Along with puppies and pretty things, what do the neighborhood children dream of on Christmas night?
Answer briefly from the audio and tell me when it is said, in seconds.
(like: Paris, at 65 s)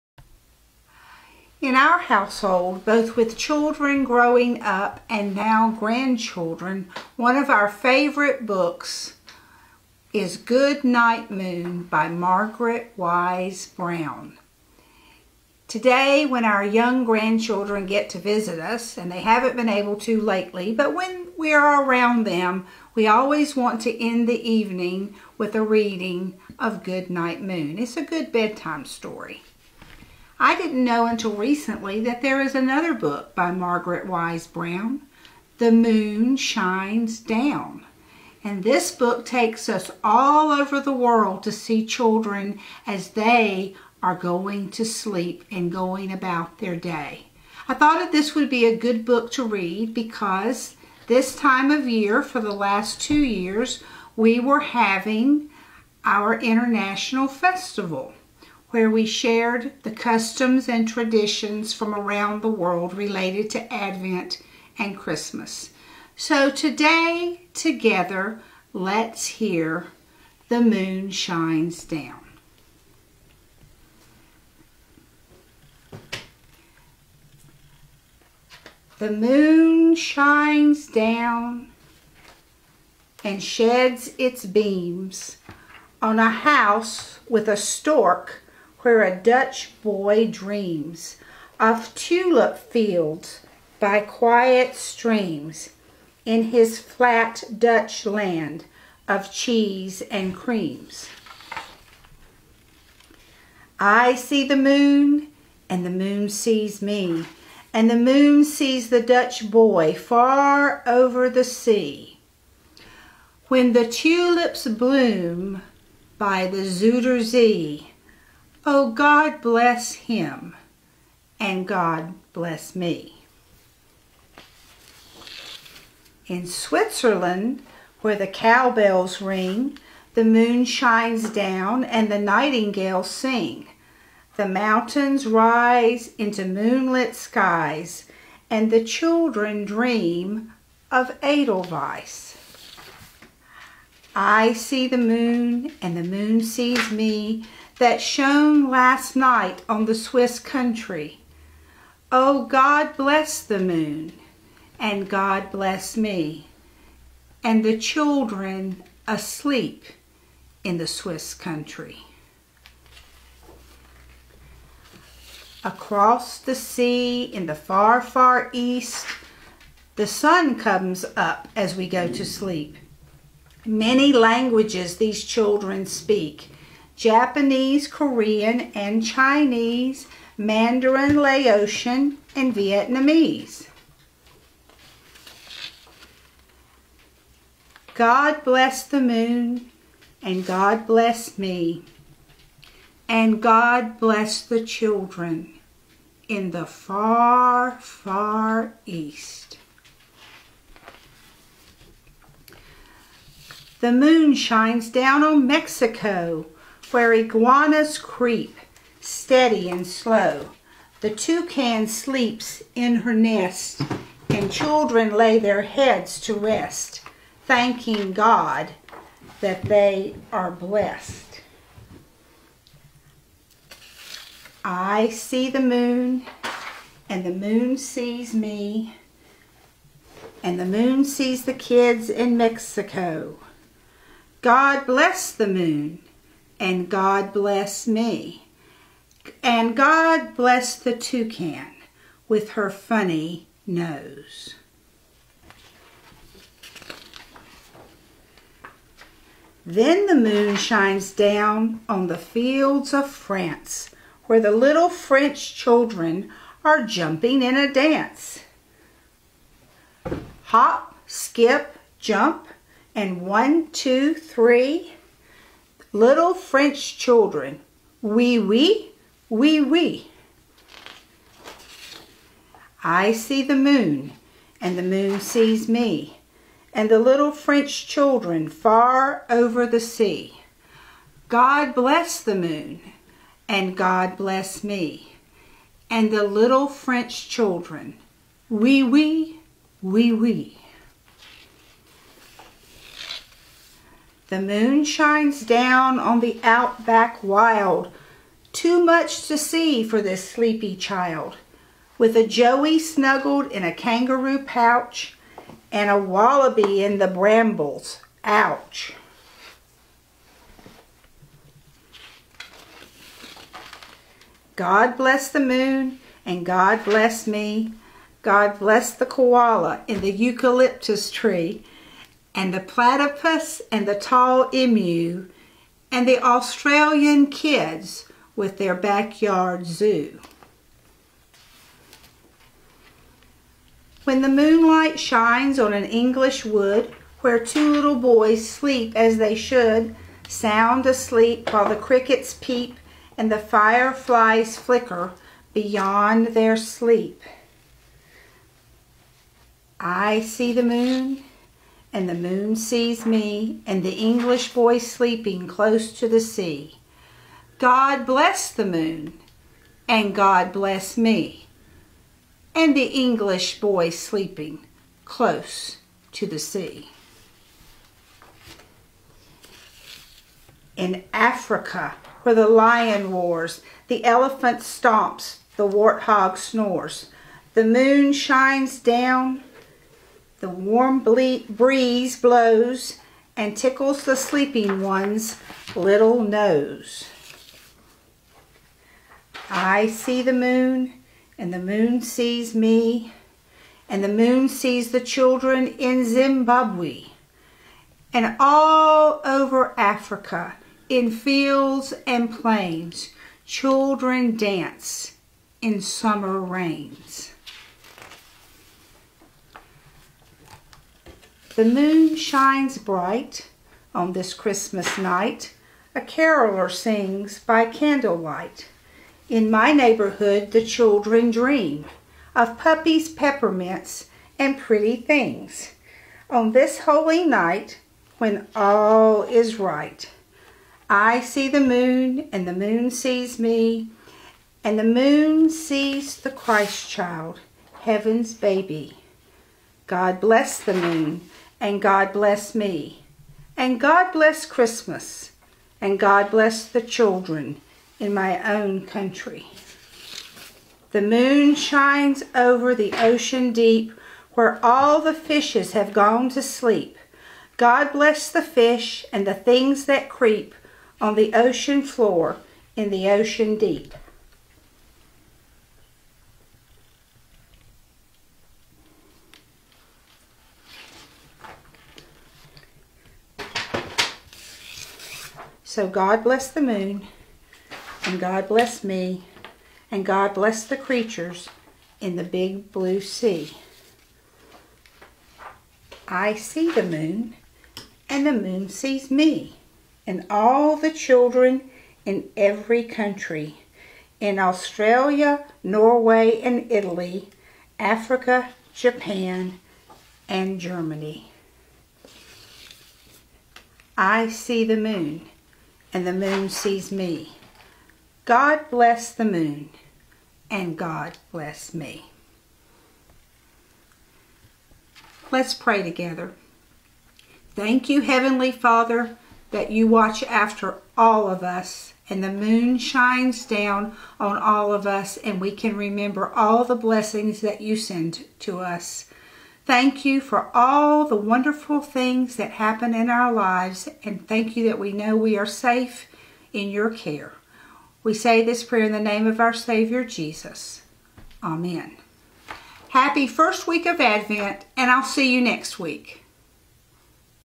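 Peppermints, at 423 s.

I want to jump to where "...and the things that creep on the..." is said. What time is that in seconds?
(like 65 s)
459 s.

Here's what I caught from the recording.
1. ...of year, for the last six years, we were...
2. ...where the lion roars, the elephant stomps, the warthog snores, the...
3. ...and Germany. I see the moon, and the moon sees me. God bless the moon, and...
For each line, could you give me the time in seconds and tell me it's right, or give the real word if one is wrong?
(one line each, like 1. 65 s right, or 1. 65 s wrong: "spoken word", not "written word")
1. 51 s wrong: "two", not "six"
2. 372 s right
3. 500 s right.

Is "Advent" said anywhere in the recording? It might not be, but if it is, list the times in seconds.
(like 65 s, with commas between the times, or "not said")
63 s, 544 s.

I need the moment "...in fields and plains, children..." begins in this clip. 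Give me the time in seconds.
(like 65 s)
400 s.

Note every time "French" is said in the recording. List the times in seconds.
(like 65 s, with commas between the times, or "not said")
254 s, 266 s, 277 s, 286 s.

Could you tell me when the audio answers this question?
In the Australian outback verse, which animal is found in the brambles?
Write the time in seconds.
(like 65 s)
305 s.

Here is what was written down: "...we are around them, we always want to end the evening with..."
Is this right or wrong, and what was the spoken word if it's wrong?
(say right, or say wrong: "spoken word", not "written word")
right.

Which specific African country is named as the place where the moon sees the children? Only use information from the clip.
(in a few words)
Zimbabwe.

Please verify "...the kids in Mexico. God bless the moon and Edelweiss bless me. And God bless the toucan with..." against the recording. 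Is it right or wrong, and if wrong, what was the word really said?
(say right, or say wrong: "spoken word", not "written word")
wrong: "God", not "Edelweiss".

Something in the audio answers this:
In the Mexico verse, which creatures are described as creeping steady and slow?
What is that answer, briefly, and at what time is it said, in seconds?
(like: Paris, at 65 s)
Iguanas, at 207 s.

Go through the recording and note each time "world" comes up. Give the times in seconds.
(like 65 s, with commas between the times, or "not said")
40 s, 62 s.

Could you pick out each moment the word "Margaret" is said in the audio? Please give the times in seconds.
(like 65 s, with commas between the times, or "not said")
12 s, 33 s.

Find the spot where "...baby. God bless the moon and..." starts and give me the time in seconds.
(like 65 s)
438 s.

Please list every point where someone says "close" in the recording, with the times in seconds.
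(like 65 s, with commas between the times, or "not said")
355 s, 365 s.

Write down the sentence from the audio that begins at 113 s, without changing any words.
When the tulips bloom by the Zuiderzee.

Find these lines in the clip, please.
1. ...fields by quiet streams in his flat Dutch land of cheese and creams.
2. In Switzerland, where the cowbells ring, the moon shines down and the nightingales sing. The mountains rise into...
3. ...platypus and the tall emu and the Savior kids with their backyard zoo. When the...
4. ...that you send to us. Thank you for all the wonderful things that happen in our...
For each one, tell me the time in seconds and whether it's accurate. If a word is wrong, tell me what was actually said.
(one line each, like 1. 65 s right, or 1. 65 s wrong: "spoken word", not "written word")
1. 92 s right
2. 126 s right
3. 322 s wrong: "Australian", not "Savior"
4. 527 s right.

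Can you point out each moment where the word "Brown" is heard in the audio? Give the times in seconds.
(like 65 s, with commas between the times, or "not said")
13 s, 34 s.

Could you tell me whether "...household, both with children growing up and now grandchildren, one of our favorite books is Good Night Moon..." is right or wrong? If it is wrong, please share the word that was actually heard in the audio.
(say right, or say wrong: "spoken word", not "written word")
right.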